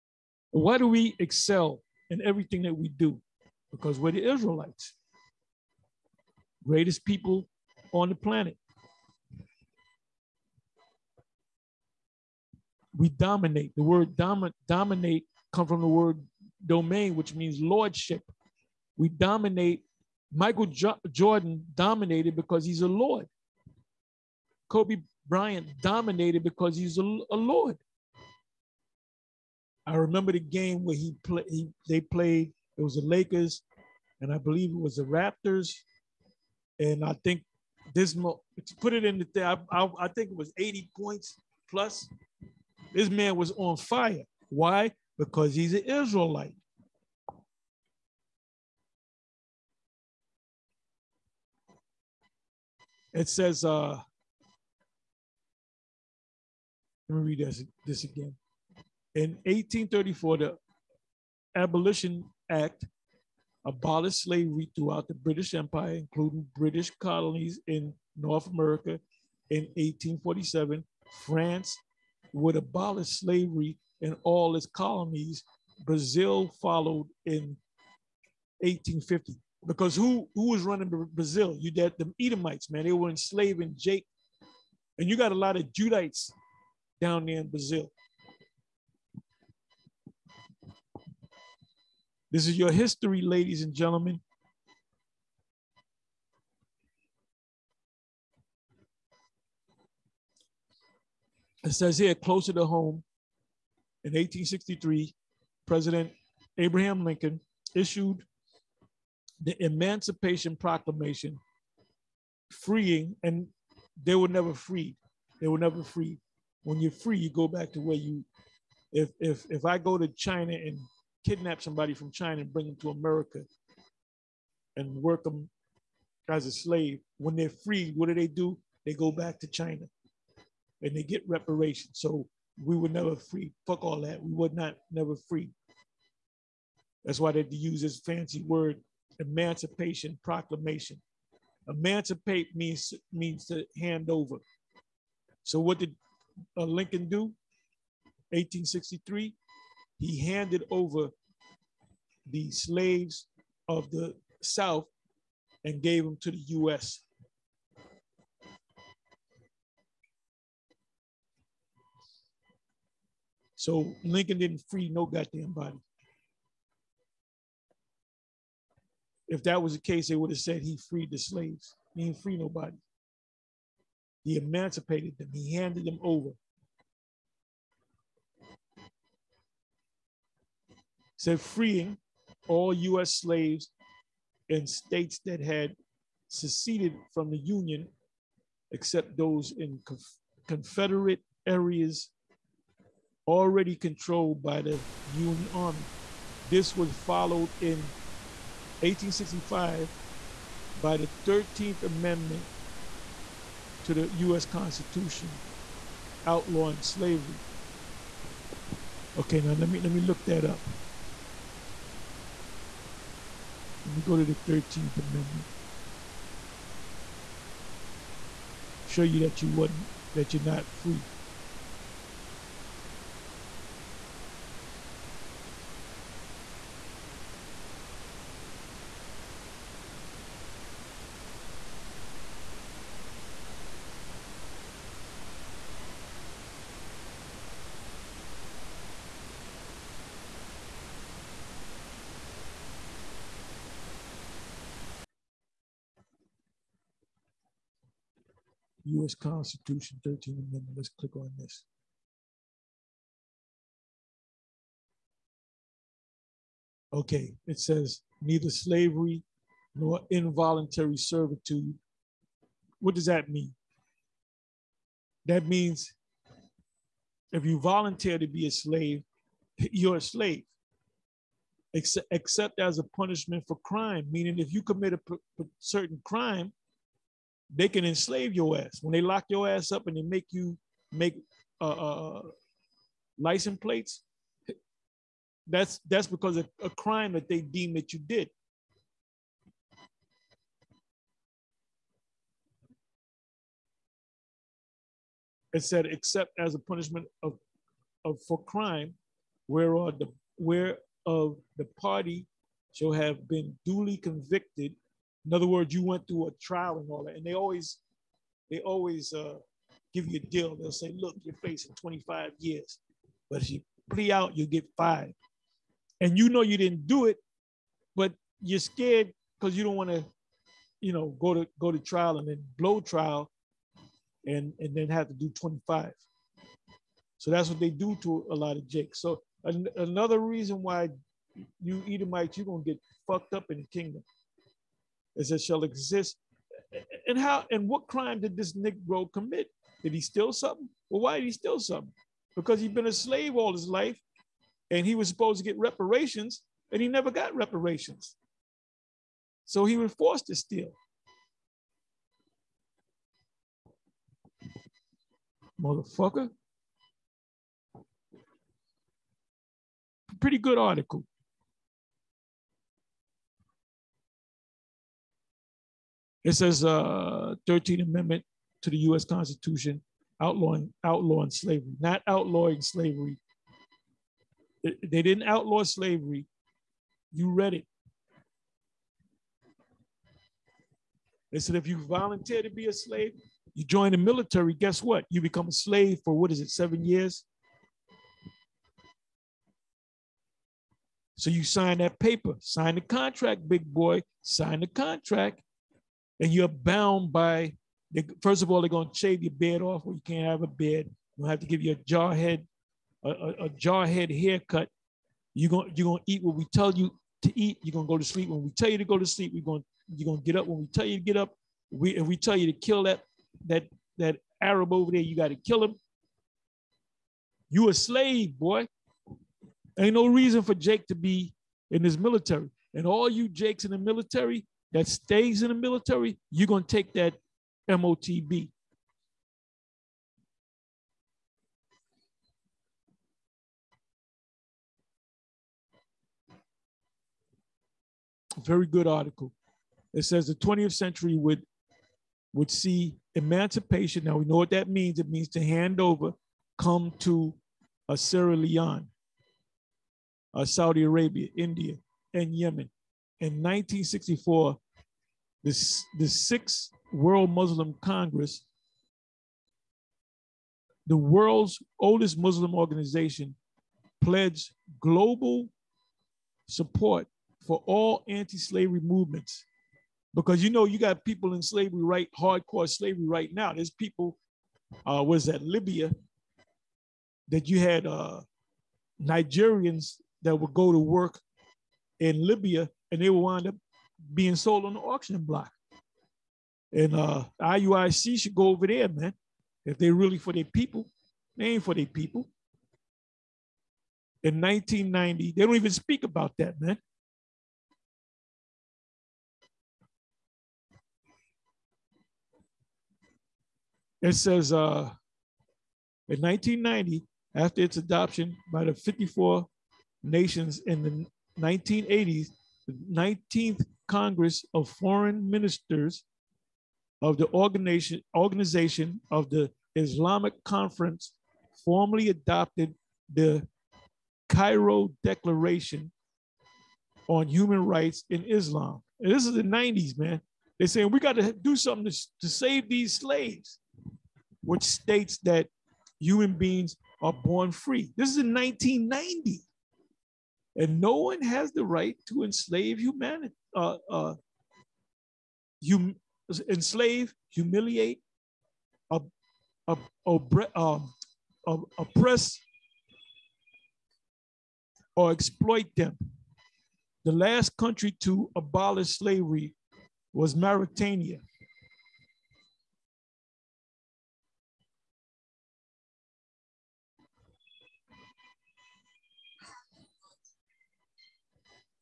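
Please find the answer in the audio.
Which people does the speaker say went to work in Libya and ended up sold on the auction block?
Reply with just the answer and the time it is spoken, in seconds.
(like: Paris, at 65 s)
Nigerians, at 479 s.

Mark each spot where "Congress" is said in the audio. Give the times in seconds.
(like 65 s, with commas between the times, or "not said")
457 s, 513 s.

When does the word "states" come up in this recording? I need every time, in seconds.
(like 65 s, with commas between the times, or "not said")
184 s, 534 s.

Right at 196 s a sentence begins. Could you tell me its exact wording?
This was followed in 1865 by the 13th Amendment to the US Constitution outlawing slavery.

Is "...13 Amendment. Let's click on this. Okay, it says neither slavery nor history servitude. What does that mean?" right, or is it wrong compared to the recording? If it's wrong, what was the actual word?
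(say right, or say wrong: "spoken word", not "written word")
wrong: "involuntary", not "history".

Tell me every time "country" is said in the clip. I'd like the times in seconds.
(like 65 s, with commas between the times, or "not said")
557 s.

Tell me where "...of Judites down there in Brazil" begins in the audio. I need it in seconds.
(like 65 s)
85 s.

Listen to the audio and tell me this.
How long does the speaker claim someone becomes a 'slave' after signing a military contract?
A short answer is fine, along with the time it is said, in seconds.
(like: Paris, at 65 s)
7 years, at 386 s.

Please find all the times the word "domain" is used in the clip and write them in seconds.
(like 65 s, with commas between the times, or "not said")
16 s.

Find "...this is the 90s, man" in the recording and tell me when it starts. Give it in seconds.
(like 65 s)
529 s.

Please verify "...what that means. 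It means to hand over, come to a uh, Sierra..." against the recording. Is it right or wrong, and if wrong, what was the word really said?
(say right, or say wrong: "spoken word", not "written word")
right.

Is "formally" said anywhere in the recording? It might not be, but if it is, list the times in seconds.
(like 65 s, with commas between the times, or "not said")
521 s.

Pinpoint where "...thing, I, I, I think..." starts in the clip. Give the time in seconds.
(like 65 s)
39 s.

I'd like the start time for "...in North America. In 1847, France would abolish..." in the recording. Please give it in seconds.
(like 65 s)
67 s.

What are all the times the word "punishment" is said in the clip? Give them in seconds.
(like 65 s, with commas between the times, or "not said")
272 s, 296 s.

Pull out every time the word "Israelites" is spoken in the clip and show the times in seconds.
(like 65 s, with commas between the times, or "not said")
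4 s, 45 s.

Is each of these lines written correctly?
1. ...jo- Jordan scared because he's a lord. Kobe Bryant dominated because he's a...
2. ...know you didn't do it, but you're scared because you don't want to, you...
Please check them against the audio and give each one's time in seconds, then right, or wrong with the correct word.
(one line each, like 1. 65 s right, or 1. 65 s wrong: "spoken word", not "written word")
1. 20 s wrong: "dominated", not "scared"
2. 316 s right.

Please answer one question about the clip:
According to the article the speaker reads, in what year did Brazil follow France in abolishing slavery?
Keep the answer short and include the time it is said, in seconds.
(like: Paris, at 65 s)
1850, at 78 s.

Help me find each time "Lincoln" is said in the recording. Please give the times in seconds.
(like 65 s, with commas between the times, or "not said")
107 s, 146 s, 164 s.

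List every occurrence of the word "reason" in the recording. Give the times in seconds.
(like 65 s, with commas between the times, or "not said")
330 s, 420 s.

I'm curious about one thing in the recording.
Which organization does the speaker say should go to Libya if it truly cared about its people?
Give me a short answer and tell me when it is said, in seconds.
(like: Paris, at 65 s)
IUIC, at 487 s.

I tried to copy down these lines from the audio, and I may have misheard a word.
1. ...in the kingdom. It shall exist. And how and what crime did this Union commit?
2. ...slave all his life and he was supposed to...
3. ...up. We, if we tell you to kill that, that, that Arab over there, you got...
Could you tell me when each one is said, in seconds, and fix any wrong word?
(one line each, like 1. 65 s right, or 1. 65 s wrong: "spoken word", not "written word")
1. 333 s wrong: "Negro", not "Union"
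2. 342 s right
3. 411 s right.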